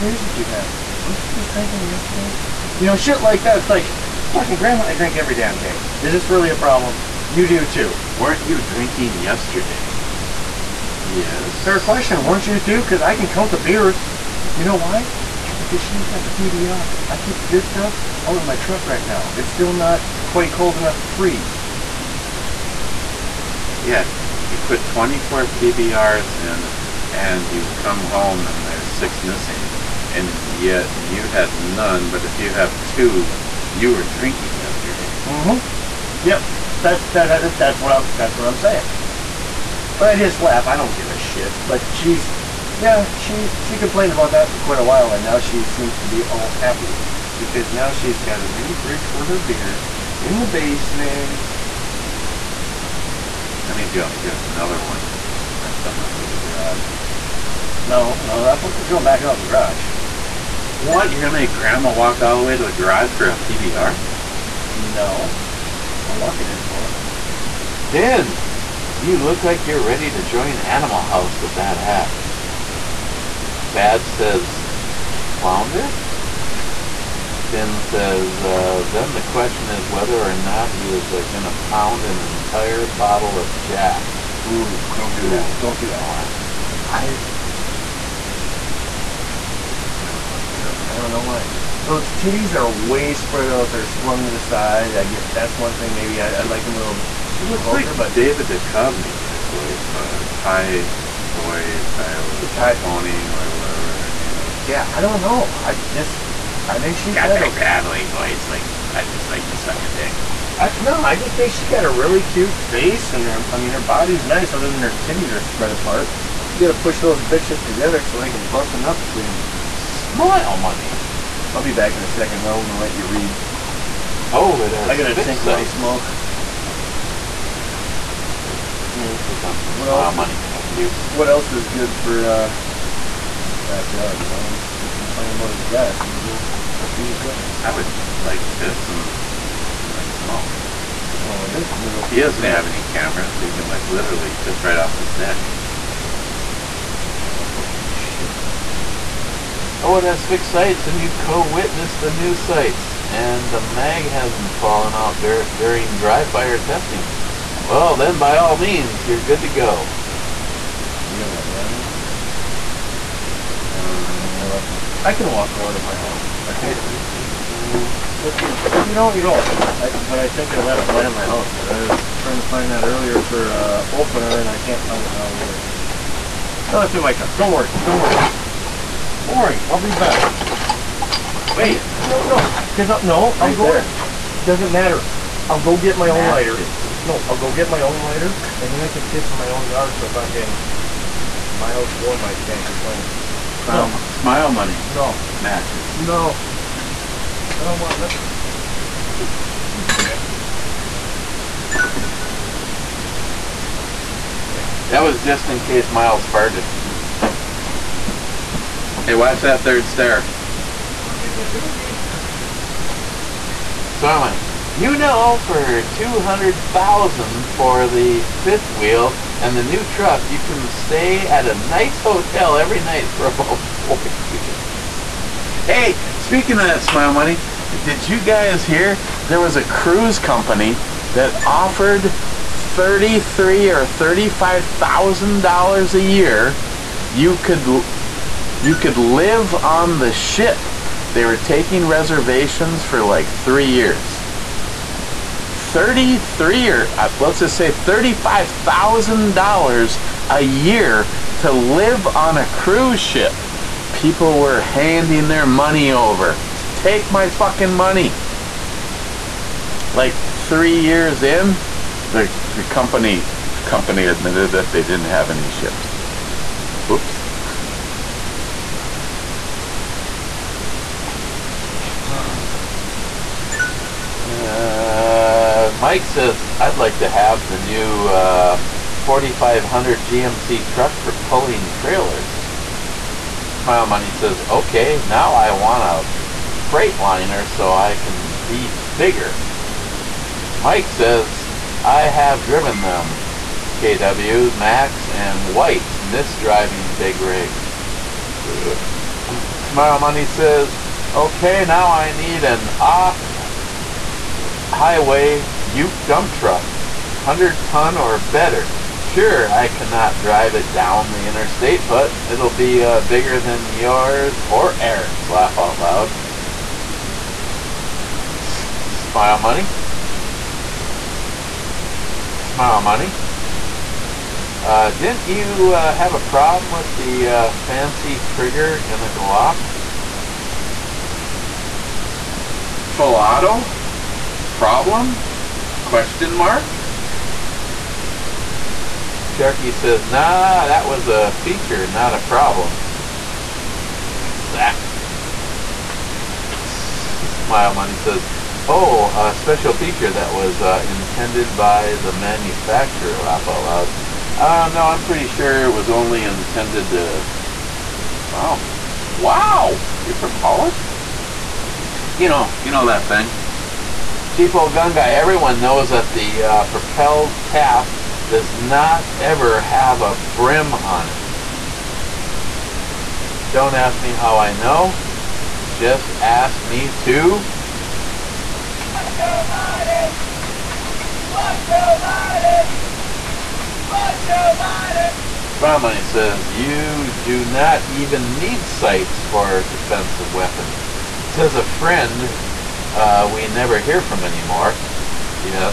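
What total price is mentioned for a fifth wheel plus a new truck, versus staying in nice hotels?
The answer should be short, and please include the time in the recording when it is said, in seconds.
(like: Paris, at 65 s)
200000, at 215 s.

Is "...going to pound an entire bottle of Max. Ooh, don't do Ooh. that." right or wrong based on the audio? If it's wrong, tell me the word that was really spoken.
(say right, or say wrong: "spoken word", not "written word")
wrong: "Jack", not "Max".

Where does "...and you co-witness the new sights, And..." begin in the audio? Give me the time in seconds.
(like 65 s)
150 s.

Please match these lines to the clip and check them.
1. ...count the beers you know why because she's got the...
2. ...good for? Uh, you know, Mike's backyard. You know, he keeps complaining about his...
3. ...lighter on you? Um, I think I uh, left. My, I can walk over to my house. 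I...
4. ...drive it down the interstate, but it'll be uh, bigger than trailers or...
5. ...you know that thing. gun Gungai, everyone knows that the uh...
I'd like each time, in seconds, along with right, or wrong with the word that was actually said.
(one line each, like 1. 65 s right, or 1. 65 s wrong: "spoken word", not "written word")
1. 13 s right
2. 131 s right
3. 161 s right
4. 310 s wrong: "yours", not "trailers"
5. 362 s right.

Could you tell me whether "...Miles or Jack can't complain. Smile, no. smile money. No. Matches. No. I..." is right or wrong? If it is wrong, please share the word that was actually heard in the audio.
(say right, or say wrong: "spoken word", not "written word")
wrong: "Mike", not "Jack".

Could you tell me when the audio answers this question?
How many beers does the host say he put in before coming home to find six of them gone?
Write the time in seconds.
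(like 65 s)
24 s.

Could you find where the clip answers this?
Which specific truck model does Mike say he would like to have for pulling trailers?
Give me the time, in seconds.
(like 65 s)
278 s.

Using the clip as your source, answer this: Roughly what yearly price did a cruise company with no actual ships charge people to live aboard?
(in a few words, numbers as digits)
$35,000.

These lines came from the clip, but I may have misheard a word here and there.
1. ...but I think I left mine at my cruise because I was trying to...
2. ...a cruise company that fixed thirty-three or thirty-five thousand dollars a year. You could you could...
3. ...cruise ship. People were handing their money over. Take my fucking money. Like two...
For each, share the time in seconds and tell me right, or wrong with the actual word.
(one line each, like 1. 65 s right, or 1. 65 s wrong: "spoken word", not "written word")
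1. 169 s wrong: "house", not "cruise"
2. 229 s wrong: "offered", not "fixed"
3. 252 s wrong: "three", not "two".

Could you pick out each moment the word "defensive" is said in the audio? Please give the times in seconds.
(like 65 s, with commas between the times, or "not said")
389 s.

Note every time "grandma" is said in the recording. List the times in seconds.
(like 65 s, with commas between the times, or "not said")
4 s, 61 s.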